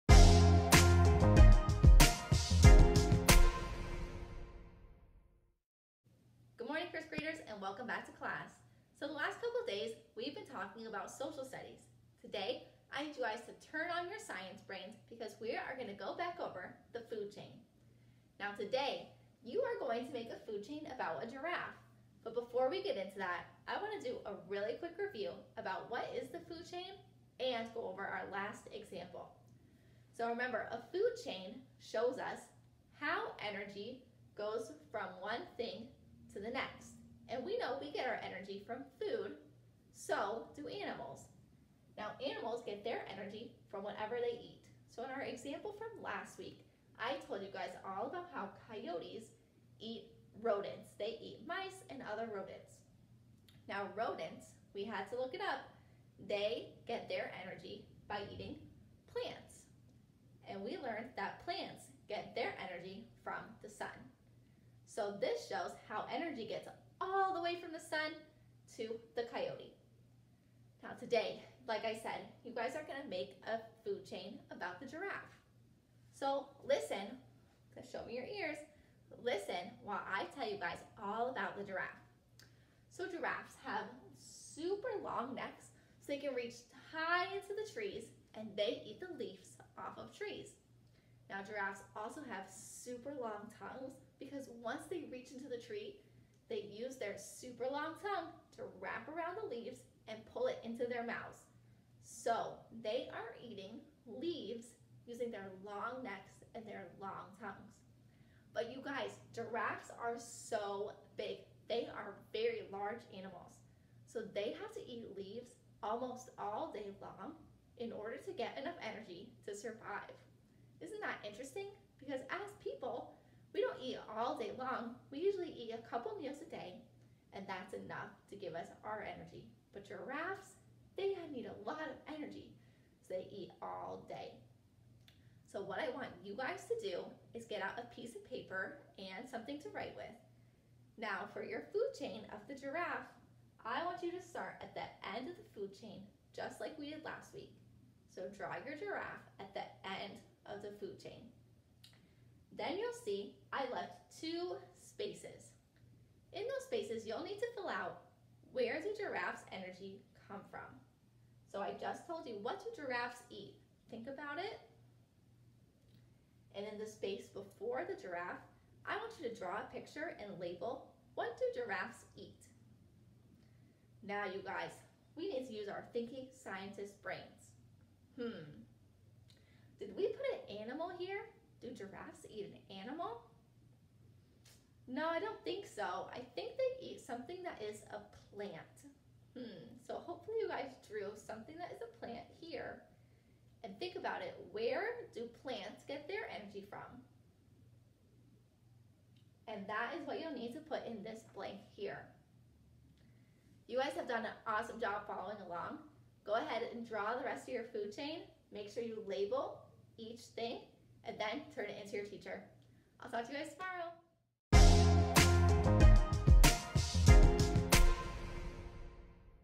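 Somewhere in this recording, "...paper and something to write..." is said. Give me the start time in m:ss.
2:18.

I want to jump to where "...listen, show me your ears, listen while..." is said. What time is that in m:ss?
1:16.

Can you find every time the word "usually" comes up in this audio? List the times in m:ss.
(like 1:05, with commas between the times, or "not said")
2:05.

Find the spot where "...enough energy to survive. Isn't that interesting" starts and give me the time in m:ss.
1:58.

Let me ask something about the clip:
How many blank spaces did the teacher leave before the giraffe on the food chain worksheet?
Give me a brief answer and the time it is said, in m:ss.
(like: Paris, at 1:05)
2, at 2:34.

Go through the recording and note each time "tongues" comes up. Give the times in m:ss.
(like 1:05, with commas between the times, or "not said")
1:33, 1:38, 1:47.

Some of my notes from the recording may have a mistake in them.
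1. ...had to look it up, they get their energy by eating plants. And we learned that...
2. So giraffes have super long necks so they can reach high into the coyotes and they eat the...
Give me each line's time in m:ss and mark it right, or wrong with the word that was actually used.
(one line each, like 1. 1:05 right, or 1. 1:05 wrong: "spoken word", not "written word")
1. 0:54 right
2. 1:22 wrong: "trees", not "coyotes".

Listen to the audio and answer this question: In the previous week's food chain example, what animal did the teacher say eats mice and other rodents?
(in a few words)
Coyotes.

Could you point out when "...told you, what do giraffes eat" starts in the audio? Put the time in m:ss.
2:42.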